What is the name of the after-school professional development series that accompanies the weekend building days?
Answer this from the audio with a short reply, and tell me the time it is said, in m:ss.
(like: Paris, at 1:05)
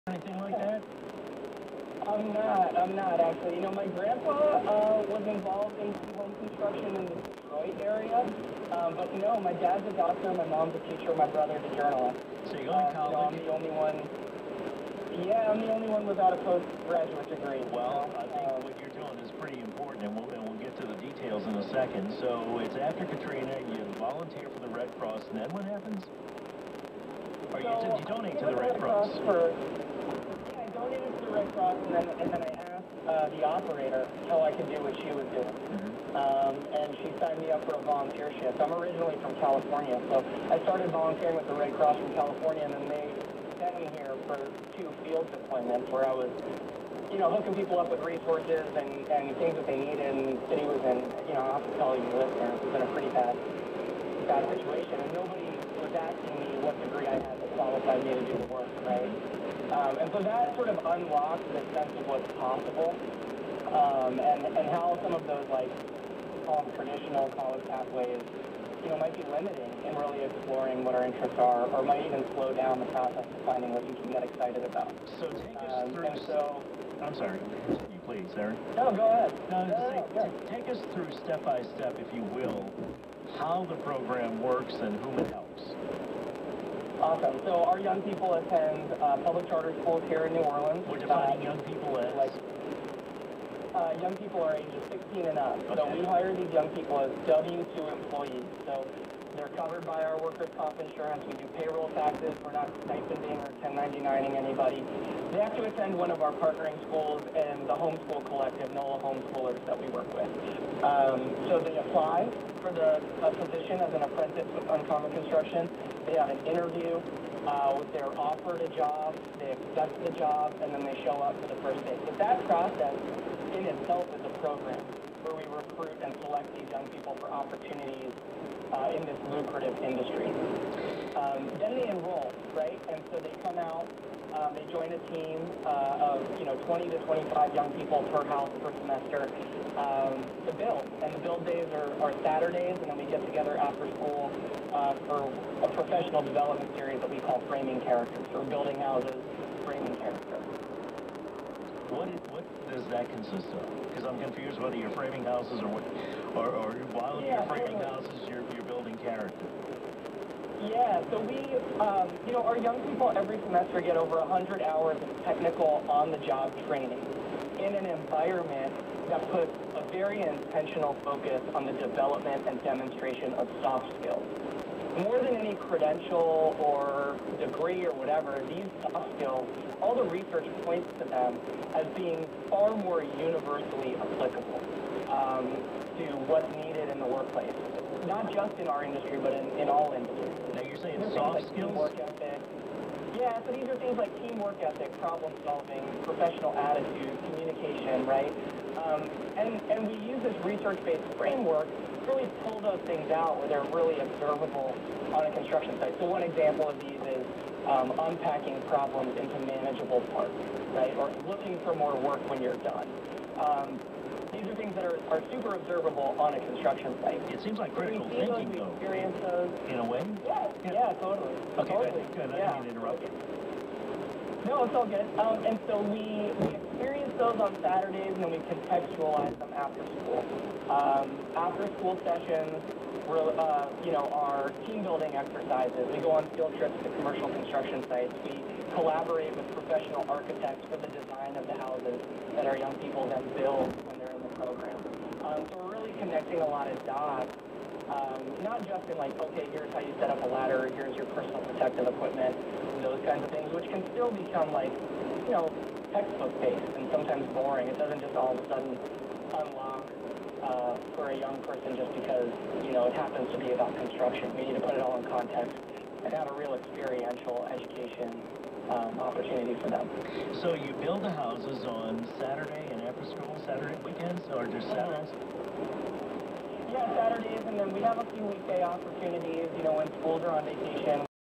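Framing Characters, at 2:27.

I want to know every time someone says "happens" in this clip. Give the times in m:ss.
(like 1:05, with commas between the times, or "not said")
0:25, 4:22.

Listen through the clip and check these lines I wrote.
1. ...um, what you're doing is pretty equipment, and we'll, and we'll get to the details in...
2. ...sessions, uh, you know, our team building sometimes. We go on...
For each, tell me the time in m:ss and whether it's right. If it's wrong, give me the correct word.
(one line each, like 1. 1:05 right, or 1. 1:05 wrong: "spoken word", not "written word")
1. 0:18 wrong: "important", not "equipment"
2. 3:52 wrong: "exercises", not "sometimes".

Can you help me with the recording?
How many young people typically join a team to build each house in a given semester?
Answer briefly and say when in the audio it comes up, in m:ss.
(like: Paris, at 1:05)
20 to 25, at 2:16.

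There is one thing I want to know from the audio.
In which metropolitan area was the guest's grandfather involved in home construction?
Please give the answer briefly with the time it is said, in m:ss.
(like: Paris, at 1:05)
Detroit, at 0:07.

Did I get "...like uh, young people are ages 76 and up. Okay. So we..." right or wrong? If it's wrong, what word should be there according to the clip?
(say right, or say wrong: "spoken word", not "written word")
wrong: "16", not "76".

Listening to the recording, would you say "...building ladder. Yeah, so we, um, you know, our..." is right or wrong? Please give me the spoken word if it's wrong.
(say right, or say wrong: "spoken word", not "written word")
wrong: "character", not "ladder".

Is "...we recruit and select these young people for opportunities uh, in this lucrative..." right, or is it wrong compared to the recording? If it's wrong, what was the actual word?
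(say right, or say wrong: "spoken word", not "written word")
right.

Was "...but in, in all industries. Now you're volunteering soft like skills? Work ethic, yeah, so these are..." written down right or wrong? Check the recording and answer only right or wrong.
wrong.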